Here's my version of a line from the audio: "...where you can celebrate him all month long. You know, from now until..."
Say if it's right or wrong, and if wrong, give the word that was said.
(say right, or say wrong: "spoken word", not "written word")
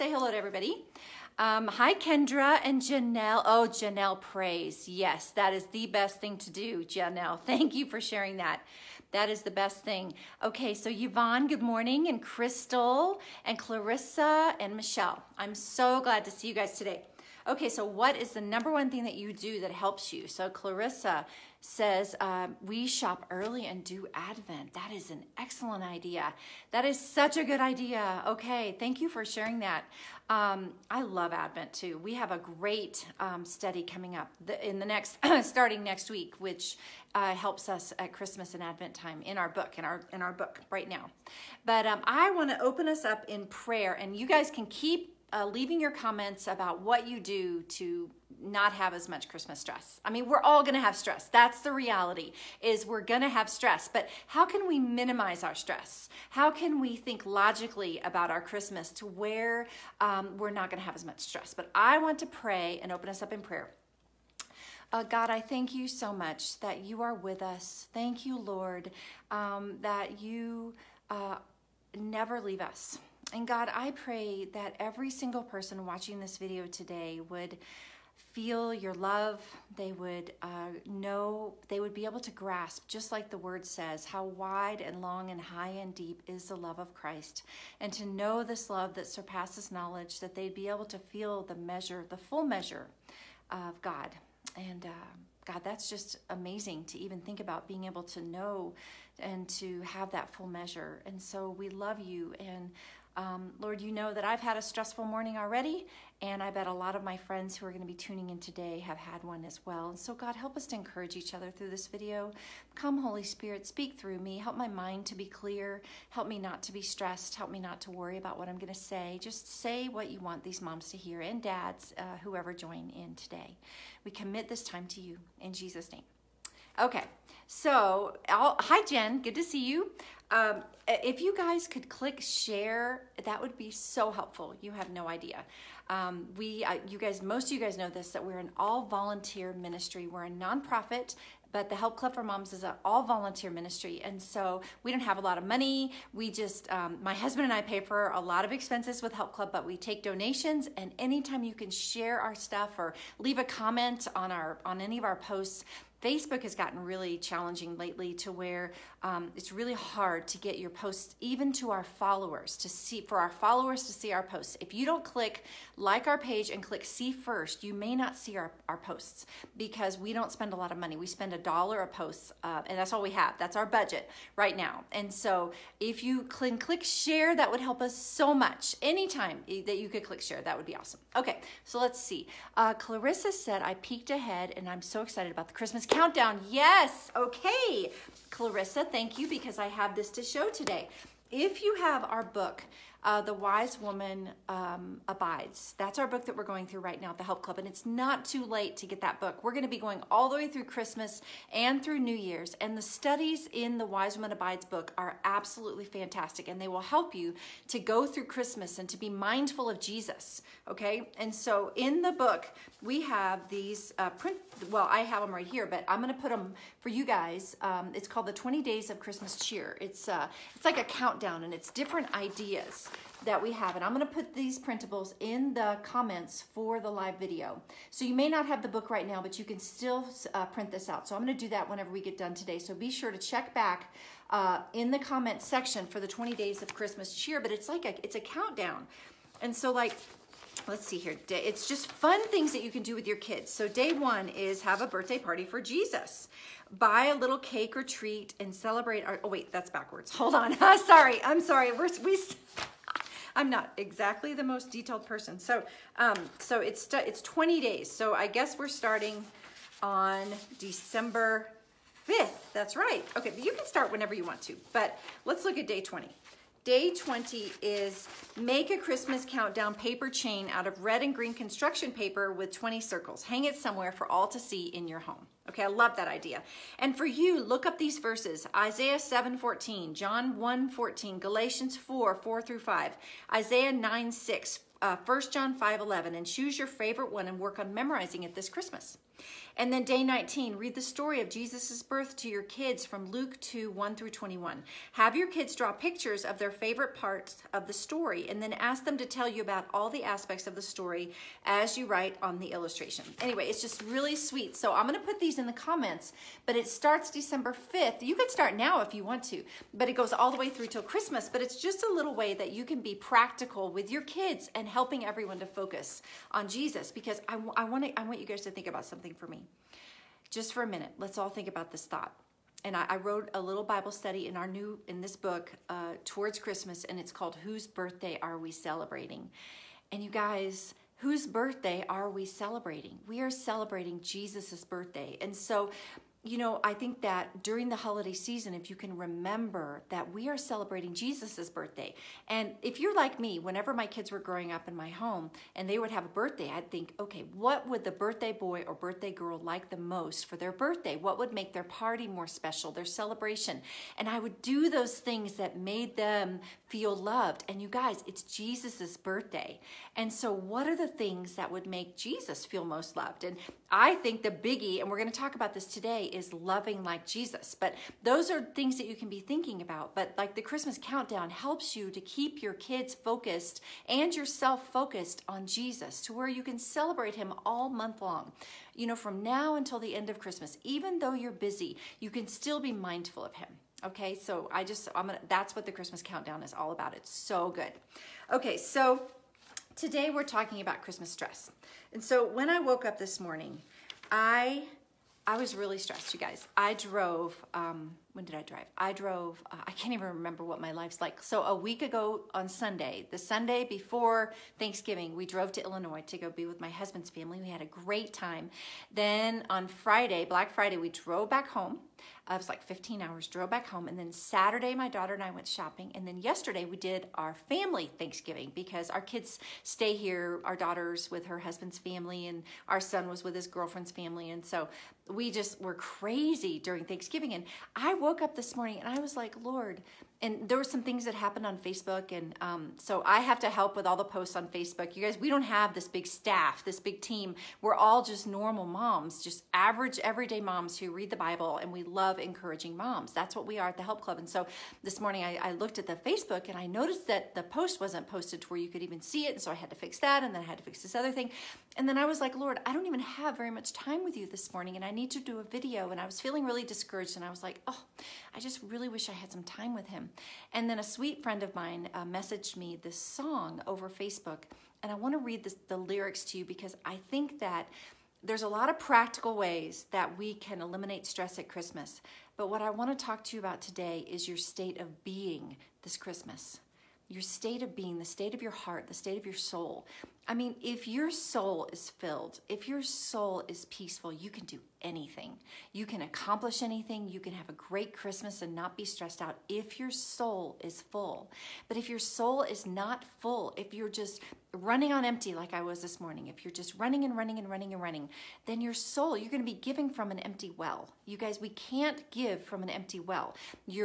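right.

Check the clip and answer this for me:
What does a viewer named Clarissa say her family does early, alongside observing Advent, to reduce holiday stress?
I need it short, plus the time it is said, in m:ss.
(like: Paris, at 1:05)
Shop, at 0:22.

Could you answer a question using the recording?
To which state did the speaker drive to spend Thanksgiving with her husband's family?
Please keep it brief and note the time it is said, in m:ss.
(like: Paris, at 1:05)
Illinois, at 6:45.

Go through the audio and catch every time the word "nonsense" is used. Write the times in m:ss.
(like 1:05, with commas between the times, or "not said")
not said.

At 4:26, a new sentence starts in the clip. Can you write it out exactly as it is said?
Day 20 is make a Christmas countdown paper chain out of red and green construction paper with 20 circles.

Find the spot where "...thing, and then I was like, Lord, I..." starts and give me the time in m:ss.
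7:31.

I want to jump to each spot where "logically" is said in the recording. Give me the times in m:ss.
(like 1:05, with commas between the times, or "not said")
0:57.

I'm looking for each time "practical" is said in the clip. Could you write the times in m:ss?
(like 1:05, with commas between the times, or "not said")
5:12, 7:48.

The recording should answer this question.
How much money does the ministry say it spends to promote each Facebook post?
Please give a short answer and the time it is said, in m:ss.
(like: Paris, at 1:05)
A dollar, at 2:51.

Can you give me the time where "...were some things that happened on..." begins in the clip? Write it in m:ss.
7:10.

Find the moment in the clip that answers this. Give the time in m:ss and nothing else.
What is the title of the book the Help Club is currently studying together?
3:13.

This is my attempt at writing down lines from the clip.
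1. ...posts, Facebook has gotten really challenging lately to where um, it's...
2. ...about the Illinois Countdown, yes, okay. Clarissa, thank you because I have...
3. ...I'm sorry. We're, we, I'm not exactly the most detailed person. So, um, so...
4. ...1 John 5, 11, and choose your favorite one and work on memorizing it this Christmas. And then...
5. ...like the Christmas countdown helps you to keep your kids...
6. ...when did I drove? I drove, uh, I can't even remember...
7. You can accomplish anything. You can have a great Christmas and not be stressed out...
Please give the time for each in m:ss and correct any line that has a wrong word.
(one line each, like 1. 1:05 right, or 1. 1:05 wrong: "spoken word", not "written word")
1. 2:35 right
2. 3:05 wrong: "Christmas", not "Illinois"
3. 4:11 right
4. 4:44 right
5. 6:10 right
6. 6:38 wrong: "drive", not "drove"
7. 8:05 right.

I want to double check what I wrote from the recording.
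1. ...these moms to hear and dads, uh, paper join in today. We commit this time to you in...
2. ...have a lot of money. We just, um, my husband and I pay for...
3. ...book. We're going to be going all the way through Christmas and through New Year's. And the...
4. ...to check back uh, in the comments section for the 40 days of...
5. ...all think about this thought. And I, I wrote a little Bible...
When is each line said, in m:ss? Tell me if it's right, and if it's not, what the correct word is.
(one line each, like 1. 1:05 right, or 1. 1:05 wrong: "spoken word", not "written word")
1. 2:00 wrong: "whoever", not "paper"
2. 2:25 right
3. 3:19 right
4. 3:53 wrong: "20", not "40"
5. 5:21 right.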